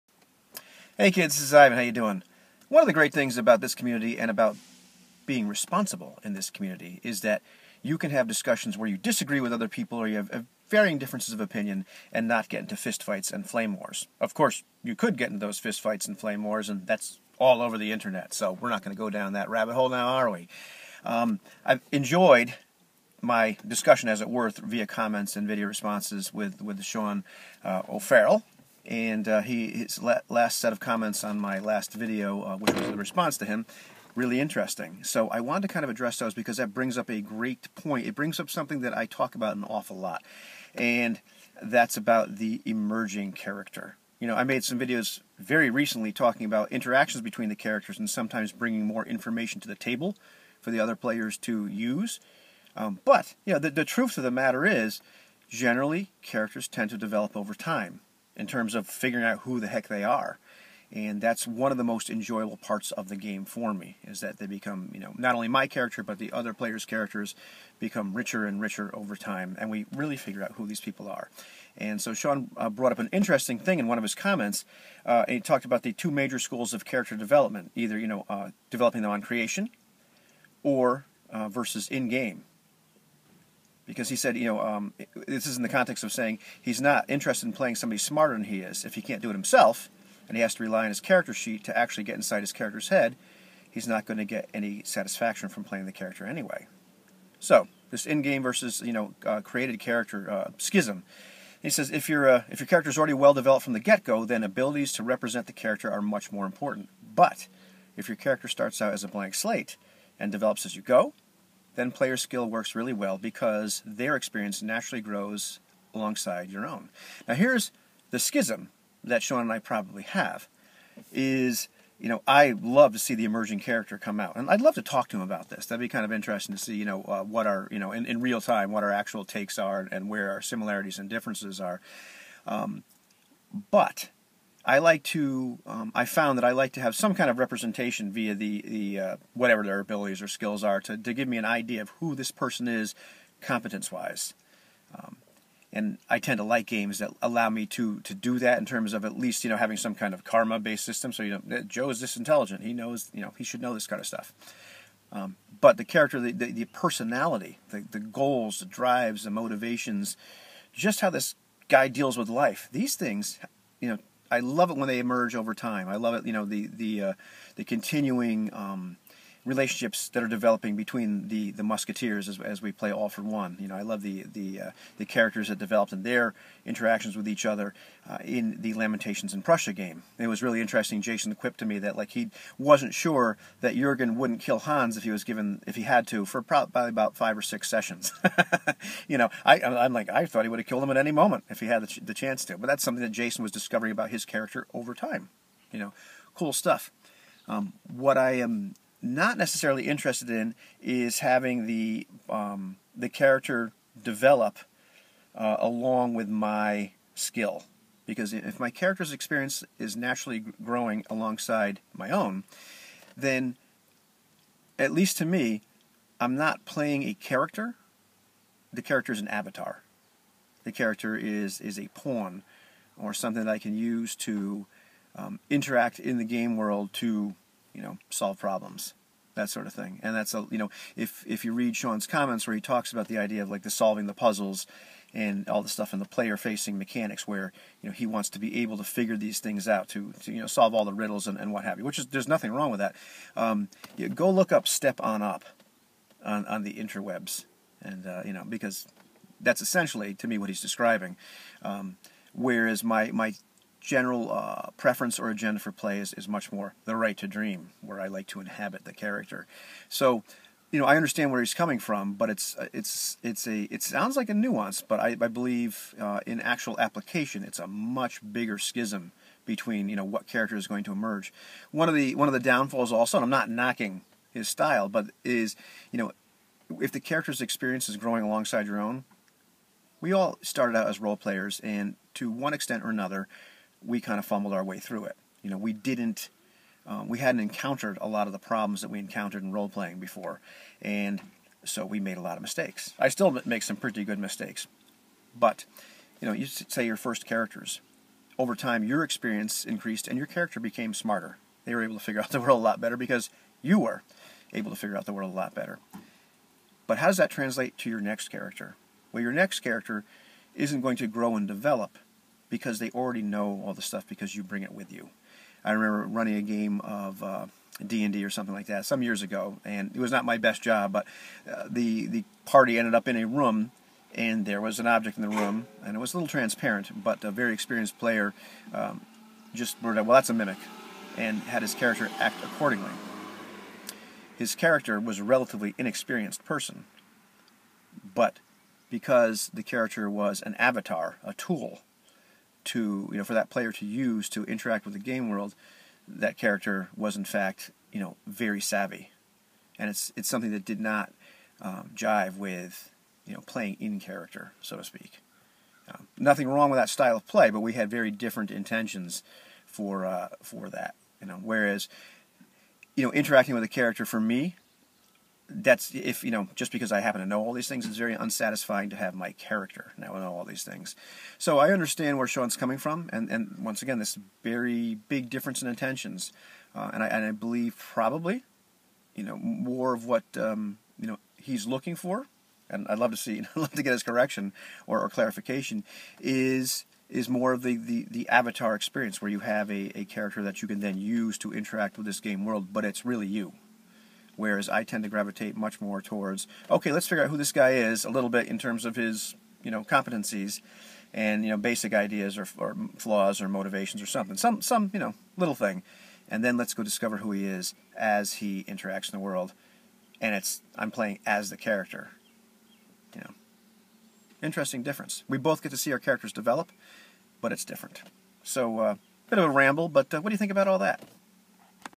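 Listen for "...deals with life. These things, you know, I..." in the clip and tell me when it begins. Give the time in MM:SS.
02:41.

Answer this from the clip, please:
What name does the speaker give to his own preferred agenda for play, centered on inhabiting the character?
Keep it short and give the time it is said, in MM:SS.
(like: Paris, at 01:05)
Right to Dream, at 04:16.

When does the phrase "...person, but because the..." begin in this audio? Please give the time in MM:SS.
05:36.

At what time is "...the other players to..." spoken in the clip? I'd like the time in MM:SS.
00:50.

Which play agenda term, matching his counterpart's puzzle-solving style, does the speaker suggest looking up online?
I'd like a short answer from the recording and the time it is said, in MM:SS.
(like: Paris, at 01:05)
Step on Up, at 04:04.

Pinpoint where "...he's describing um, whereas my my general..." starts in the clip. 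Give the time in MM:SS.
04:10.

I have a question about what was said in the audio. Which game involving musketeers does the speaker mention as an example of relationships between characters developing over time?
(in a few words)
All for One.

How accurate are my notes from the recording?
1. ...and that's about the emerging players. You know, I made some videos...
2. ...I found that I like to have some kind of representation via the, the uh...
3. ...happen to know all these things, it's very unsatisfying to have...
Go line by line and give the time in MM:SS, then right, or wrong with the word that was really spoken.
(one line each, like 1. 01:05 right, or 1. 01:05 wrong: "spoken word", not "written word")
1. 00:40 wrong: "character", not "players"
2. 02:15 right
3. 06:06 right.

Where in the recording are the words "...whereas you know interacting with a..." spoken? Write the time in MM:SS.
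06:01.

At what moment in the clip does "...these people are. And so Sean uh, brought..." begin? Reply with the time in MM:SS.
01:10.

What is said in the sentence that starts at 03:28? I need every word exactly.
Because if my character's experience is naturally growing alongside my own, then at least to me, I'm not playing a character.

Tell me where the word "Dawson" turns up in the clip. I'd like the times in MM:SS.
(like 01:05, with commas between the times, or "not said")
not said.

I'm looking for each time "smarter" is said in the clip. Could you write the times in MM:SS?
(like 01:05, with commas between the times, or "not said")
01:27, 05:00.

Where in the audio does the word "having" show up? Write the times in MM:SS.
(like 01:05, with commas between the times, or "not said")
02:29, 03:21.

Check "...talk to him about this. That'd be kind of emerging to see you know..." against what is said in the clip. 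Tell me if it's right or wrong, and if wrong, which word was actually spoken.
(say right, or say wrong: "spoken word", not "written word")
wrong: "interesting", not "emerging".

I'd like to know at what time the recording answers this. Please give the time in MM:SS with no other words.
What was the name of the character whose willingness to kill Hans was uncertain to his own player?
03:03.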